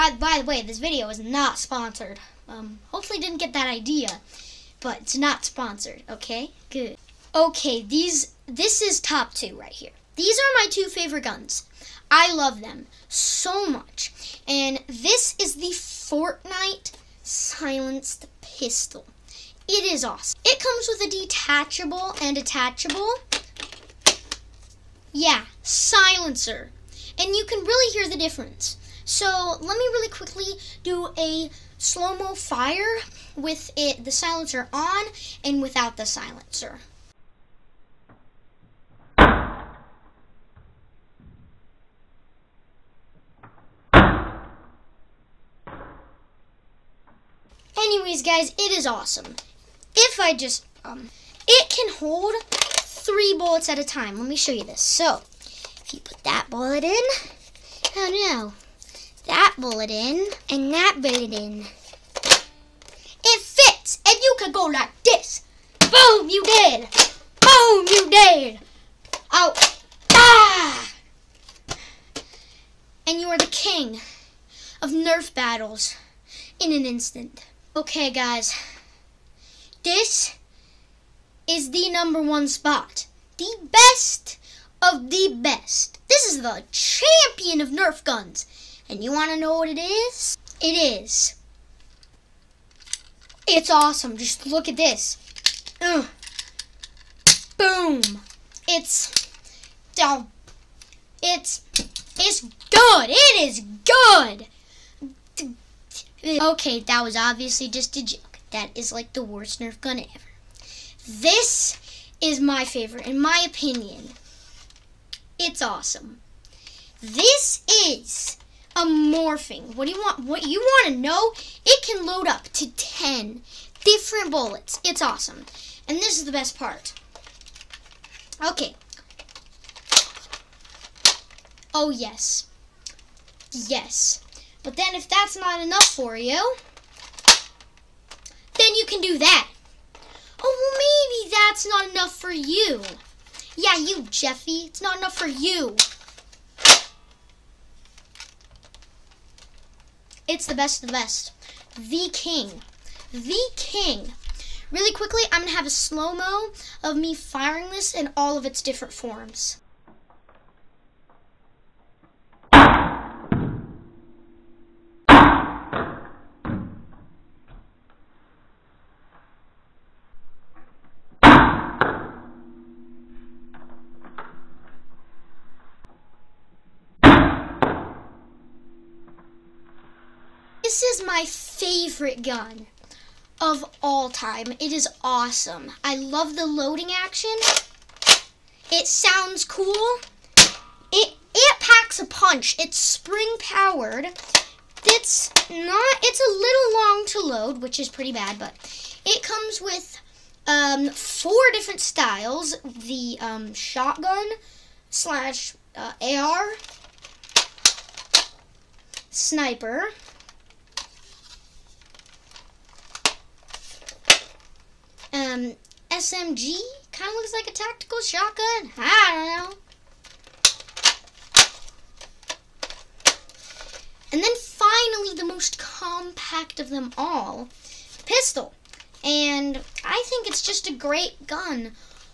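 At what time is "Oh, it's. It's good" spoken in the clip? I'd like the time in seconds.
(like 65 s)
100 s.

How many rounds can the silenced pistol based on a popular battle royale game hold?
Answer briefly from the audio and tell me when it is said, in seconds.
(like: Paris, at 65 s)
3, at 52 s.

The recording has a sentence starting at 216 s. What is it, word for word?
Kind of looks like a tactical shotgun.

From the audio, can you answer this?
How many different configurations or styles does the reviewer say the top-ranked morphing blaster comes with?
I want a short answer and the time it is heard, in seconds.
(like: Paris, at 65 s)
4, at 200 s.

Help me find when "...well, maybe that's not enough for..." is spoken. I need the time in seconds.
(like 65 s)
140 s.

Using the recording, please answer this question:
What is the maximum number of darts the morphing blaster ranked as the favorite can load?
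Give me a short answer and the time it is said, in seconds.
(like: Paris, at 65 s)
10, at 122 s.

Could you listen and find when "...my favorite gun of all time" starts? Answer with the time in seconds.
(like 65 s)
181 s.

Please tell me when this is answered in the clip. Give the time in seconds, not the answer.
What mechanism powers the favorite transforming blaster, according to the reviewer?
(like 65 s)
192 s.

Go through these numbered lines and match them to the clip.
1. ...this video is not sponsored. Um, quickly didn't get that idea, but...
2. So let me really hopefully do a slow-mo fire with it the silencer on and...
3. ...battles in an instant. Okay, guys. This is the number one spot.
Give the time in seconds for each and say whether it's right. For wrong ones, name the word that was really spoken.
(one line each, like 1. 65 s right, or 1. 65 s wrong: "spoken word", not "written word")
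1. 0 s wrong: "hopefully", not "quickly"
2. 29 s wrong: "quickly", not "hopefully"
3. 75 s right.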